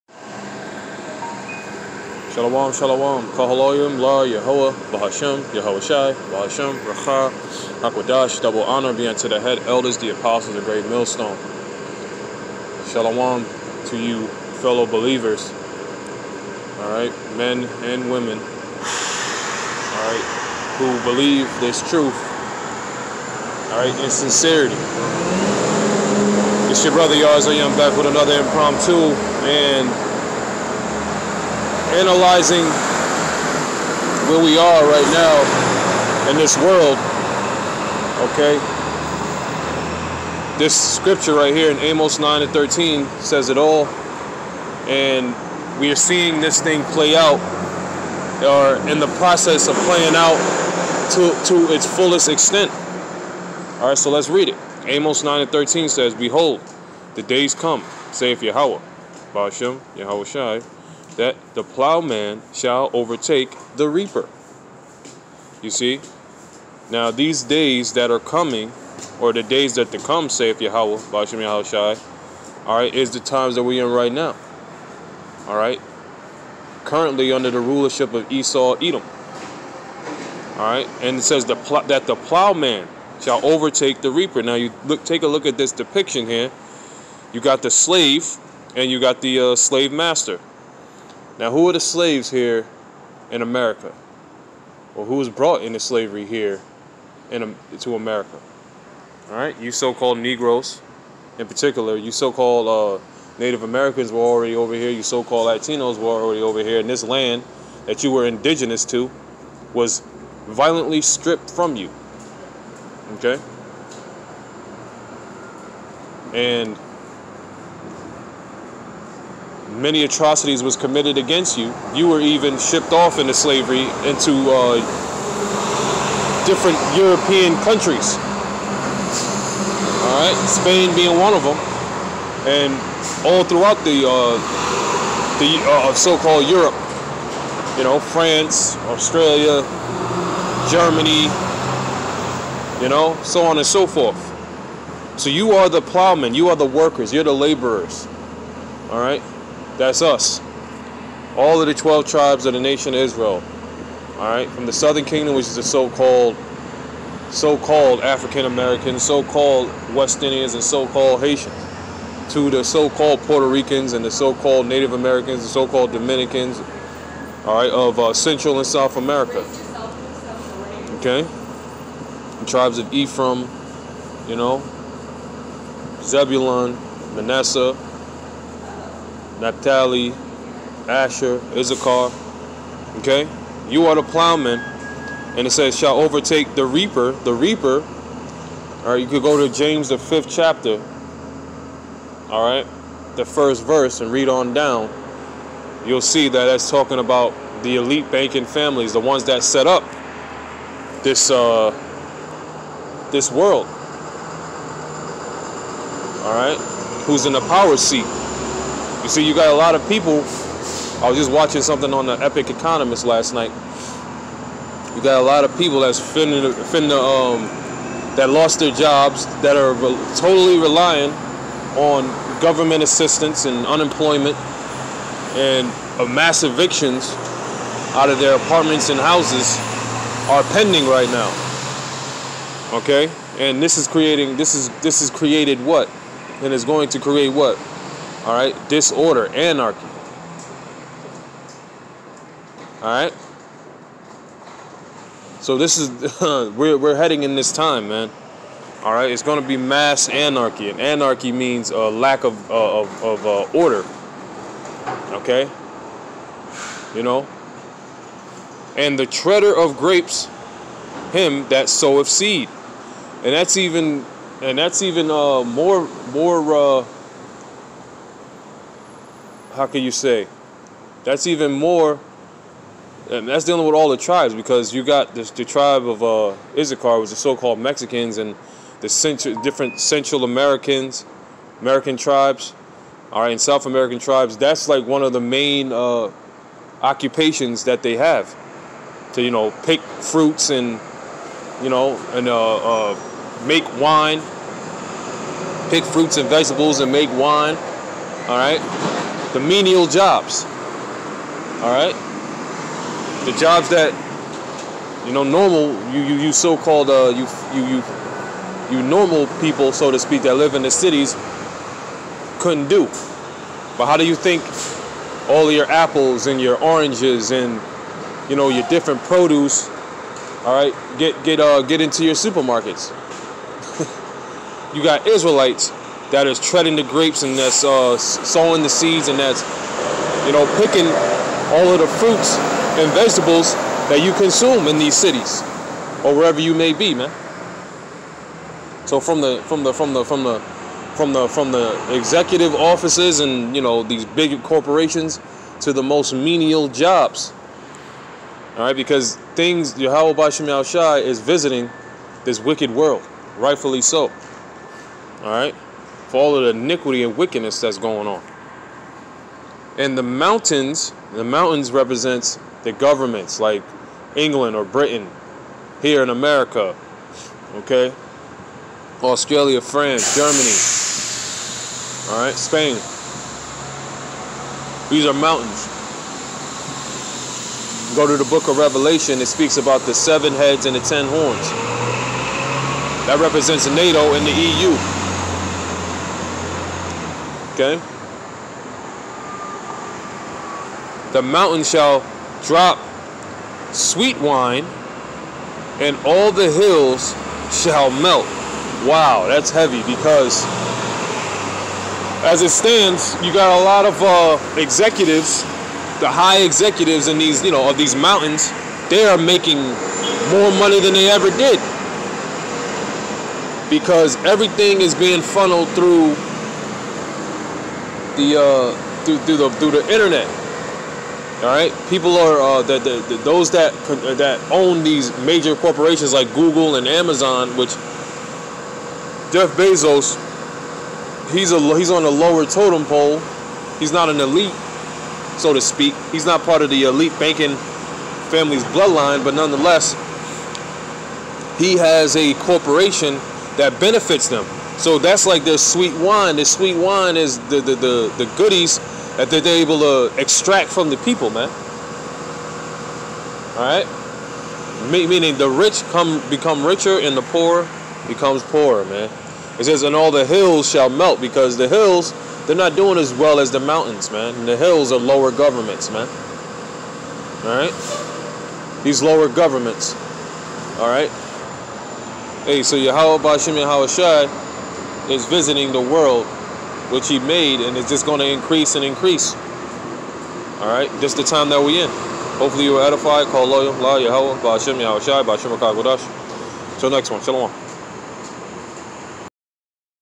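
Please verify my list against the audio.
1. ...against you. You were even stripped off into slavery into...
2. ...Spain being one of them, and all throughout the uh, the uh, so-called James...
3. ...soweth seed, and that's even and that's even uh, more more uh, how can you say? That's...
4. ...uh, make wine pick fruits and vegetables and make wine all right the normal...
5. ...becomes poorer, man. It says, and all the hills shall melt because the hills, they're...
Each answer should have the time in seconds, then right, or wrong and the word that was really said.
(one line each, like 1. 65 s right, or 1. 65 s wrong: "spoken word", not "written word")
1. 121 s wrong: "shipped", not "stripped"
2. 130 s wrong: "Europe", not "James"
3. 261 s right
4. 292 s wrong: "menial", not "normal"
5. 458 s right.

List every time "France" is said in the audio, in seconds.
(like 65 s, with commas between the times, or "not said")
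137 s, 369 s.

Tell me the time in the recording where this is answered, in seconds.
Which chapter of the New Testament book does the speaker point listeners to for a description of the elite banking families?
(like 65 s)
189 s.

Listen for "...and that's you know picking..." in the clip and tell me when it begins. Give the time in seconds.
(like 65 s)
329 s.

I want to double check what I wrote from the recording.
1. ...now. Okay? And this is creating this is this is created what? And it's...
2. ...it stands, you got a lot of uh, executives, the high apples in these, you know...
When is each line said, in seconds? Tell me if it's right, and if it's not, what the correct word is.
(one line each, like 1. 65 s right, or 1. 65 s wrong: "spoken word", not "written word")
1. 231 s right
2. 402 s wrong: "executives", not "apples".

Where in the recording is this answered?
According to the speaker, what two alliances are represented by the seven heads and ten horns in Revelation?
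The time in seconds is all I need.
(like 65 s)
383 s.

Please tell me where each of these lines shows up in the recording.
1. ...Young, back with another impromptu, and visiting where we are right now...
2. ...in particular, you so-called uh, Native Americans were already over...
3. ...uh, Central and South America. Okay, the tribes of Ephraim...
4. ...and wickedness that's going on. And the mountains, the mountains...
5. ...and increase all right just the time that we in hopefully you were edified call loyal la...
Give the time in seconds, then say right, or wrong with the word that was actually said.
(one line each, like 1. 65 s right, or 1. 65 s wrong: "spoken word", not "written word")
1. 27 s wrong: "analyzing", not "visiting"
2. 101 s right
3. 167 s right
4. 357 s right
5. 478 s right.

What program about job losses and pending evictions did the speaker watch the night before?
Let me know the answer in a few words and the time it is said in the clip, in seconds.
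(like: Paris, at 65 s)
The Epic Economist, at 212 s.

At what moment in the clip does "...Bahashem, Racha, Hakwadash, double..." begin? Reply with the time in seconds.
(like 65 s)
6 s.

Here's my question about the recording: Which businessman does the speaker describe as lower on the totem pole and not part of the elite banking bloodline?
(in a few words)
Jeff Bezos.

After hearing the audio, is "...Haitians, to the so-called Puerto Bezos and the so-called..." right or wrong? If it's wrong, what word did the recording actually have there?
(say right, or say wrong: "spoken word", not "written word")
wrong: "Ricans", not "Bezos".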